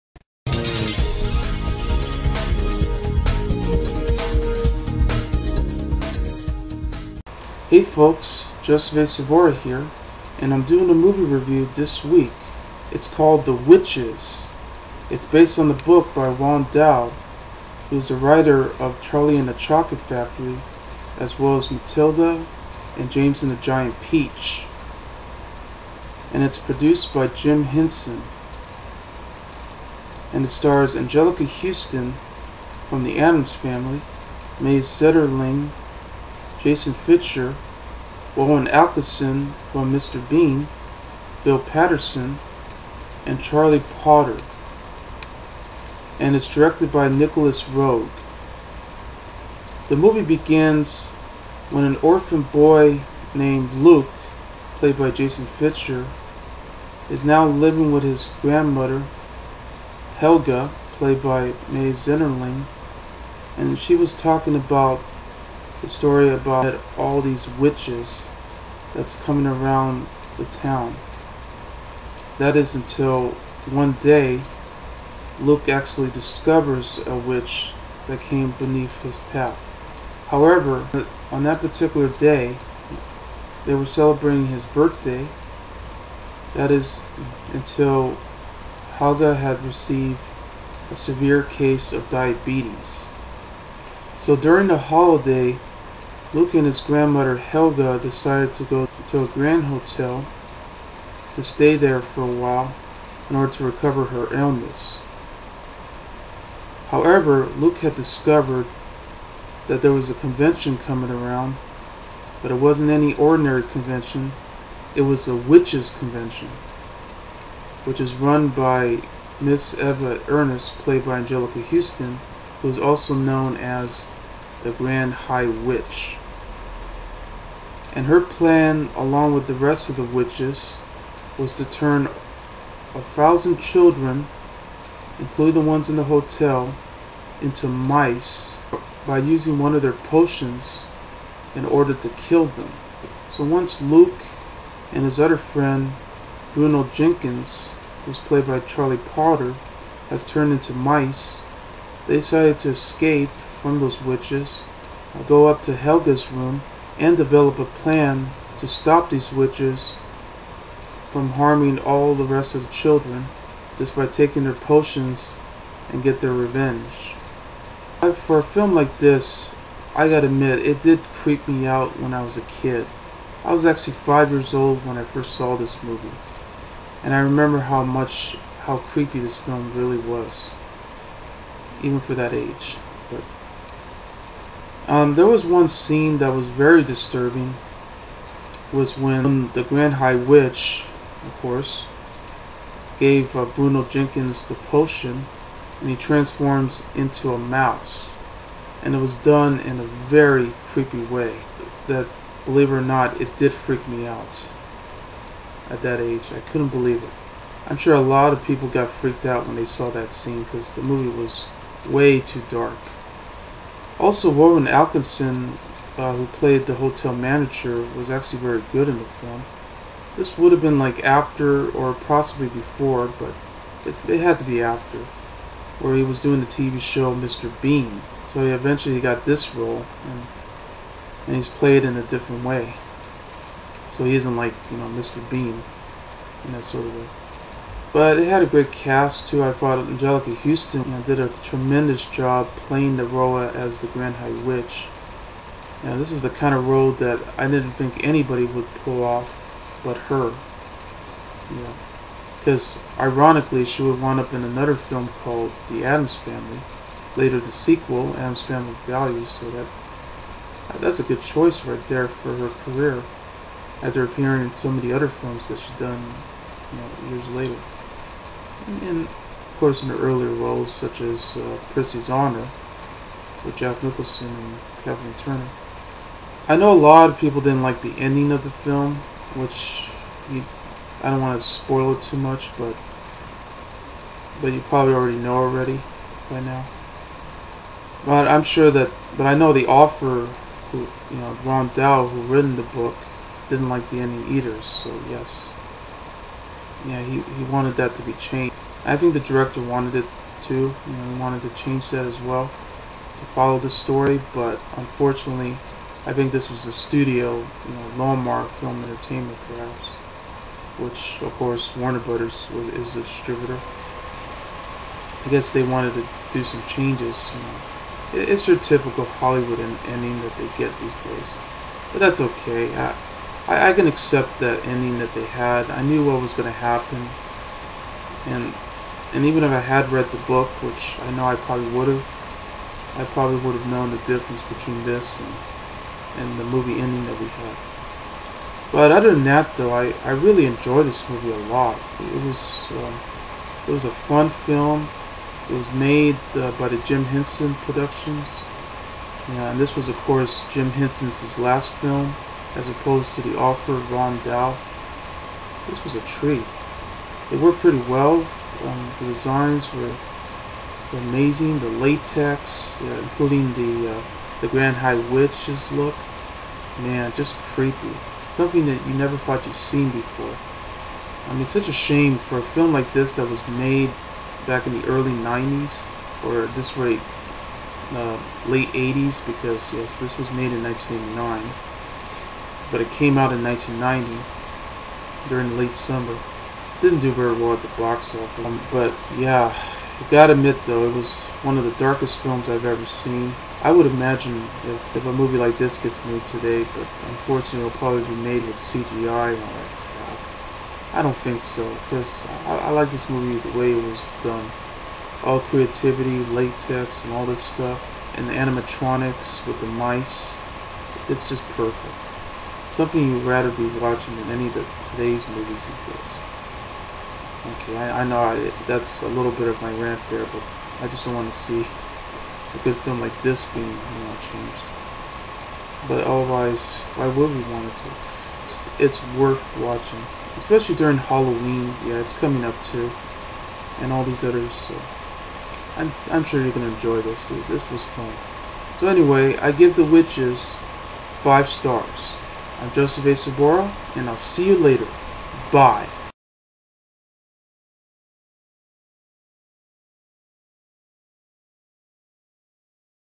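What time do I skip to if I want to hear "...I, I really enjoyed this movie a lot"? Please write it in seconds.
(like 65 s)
339 s.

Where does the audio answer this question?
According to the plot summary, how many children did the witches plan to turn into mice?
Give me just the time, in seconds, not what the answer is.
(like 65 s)
132 s.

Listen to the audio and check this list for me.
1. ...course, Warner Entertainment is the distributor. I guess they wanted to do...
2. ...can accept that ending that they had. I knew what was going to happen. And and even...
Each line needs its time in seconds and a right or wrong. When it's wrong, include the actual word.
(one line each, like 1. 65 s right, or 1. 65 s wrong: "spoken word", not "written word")
1. 311 s wrong: "Brothers", not "Entertainment"
2. 323 s right.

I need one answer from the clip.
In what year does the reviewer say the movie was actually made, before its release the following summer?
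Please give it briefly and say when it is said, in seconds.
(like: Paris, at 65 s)
1989, at 380 s.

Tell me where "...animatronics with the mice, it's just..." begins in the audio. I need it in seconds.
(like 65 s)
408 s.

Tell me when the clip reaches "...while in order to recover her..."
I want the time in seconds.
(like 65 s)
102 s.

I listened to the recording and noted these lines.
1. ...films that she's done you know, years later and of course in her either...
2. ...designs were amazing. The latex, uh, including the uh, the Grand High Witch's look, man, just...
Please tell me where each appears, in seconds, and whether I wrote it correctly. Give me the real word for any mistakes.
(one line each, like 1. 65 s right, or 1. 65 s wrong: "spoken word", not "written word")
1. 265 s wrong: "earlier", not "either"
2. 359 s right.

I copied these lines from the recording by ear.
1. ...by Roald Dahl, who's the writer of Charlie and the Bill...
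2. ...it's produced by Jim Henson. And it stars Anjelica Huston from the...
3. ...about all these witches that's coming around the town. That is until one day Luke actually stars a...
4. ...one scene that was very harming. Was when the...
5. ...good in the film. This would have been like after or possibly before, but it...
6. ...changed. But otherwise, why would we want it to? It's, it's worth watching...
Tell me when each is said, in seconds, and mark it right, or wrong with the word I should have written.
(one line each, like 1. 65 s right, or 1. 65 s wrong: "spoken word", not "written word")
1. 16 s wrong: "Chocolate", not "Bill"
2. 26 s right
3. 66 s wrong: "discovers", not "stars"
4. 185 s wrong: "disturbing", not "harming"
5. 218 s right
6. 424 s right.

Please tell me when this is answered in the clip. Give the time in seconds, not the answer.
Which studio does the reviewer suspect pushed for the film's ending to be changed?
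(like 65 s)
307 s.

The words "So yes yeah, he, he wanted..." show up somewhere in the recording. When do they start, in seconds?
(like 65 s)
294 s.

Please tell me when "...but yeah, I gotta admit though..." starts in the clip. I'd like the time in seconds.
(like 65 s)
388 s.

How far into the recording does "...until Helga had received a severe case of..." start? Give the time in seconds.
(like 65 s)
87 s.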